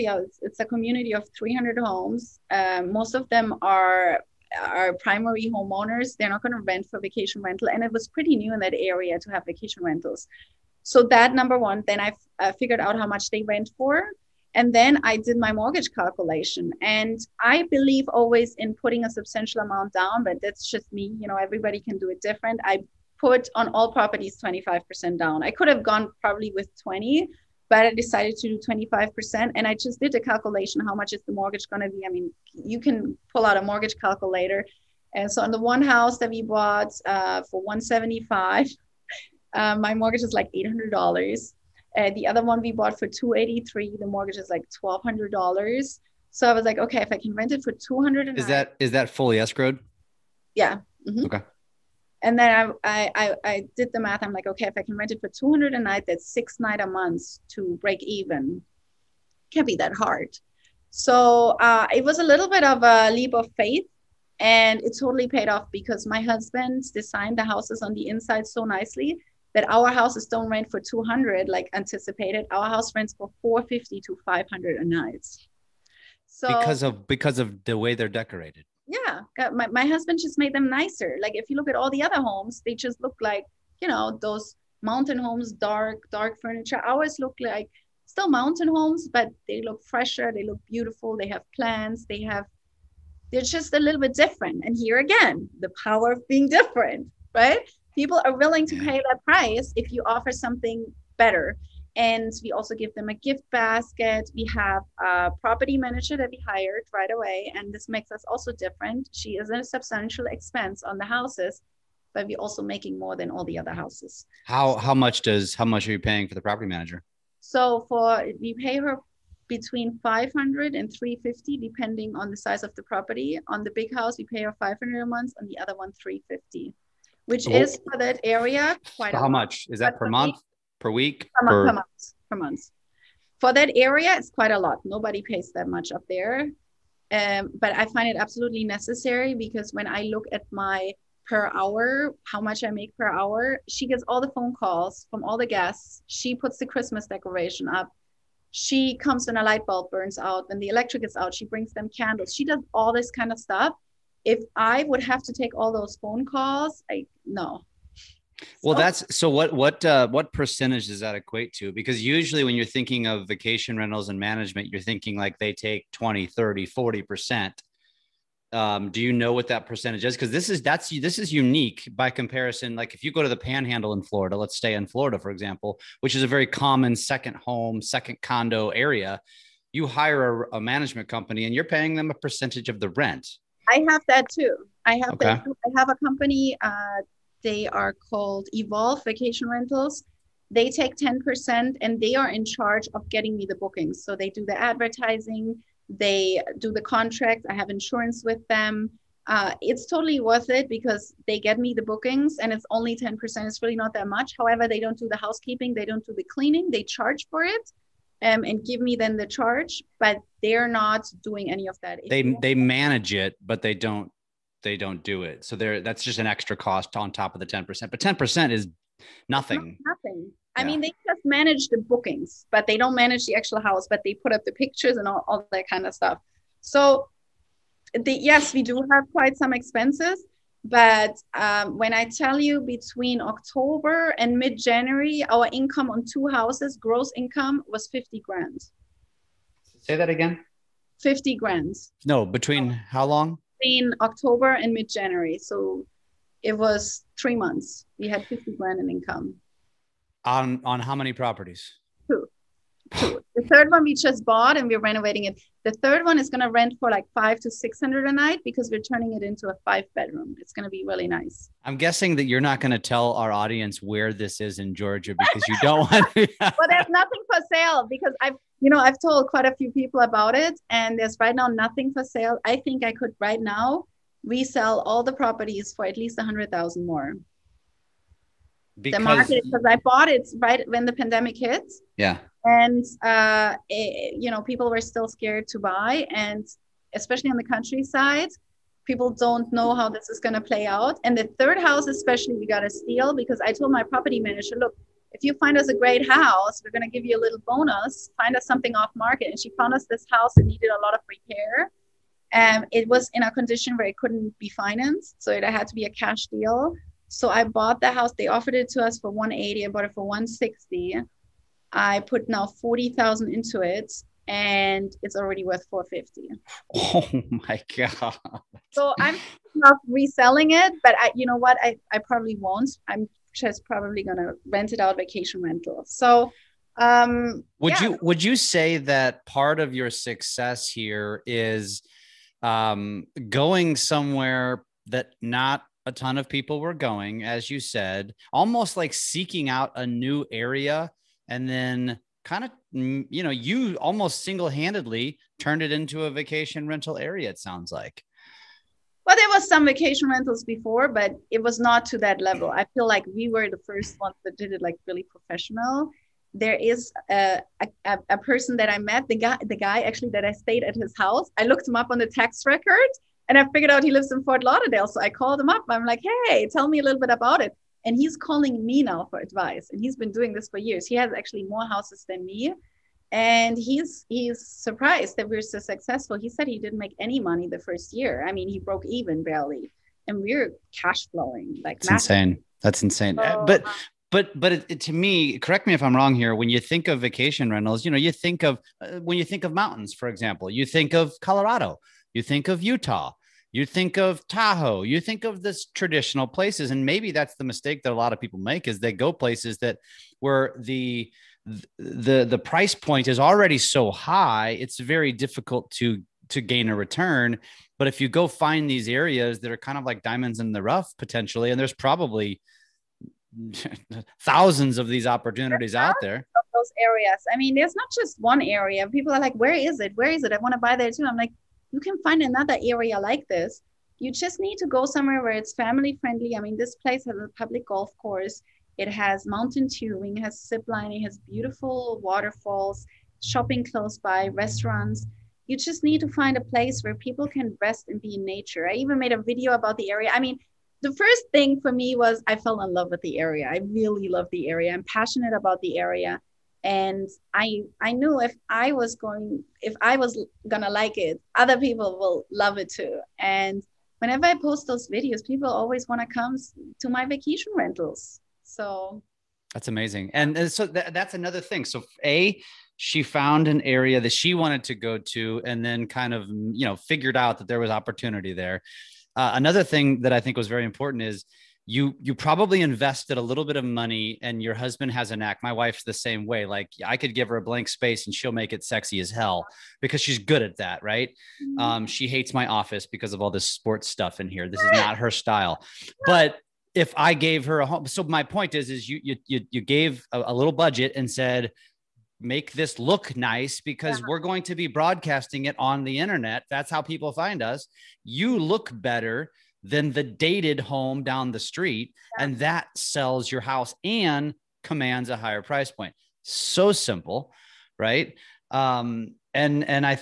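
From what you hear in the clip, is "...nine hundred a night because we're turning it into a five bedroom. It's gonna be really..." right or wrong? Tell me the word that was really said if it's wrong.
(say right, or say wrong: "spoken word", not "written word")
wrong: "six", not "nine".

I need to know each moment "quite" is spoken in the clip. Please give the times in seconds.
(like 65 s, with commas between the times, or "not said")
128 s, 134 s, 229 s, 269 s.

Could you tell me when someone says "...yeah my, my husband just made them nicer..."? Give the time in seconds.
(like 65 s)
78 s.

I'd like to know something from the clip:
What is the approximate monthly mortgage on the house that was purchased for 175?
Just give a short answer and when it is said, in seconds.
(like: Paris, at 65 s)
$800, at 40 s.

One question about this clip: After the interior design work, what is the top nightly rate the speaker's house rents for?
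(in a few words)
500.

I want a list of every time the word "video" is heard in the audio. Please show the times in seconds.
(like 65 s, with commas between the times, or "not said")
439 s, 454 s.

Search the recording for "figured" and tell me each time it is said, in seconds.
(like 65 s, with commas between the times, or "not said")
12 s, 363 s, 466 s.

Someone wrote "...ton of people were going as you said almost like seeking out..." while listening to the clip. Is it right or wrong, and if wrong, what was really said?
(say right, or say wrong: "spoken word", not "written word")
right.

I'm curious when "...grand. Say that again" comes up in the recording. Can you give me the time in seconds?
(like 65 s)
238 s.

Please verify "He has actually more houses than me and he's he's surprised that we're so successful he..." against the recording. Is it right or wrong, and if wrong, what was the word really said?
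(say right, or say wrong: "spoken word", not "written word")
right.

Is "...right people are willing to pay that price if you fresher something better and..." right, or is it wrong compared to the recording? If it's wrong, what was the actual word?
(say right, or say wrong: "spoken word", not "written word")
wrong: "offer", not "fresher".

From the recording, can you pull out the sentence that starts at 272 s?
I think I could right now resell all the properties for at least a hundred thousand more.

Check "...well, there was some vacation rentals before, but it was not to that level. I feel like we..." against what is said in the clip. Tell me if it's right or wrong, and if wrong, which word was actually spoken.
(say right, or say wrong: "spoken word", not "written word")
right.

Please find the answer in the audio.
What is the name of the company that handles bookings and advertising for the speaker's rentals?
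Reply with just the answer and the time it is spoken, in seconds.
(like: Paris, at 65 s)
Evolve Vacation Rentals, at 188 s.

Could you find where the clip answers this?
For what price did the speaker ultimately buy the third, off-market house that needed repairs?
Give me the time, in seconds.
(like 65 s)
310 s.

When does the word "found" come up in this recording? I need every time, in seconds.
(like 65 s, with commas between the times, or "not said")
299 s, 463 s.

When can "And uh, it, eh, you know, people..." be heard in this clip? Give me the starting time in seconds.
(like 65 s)
282 s.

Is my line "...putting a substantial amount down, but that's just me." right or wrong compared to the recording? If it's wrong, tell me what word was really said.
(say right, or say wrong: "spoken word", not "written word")
right.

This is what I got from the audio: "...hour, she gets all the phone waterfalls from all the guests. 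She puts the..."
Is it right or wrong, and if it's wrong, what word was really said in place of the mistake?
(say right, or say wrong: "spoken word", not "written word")
wrong: "calls", not "waterfalls".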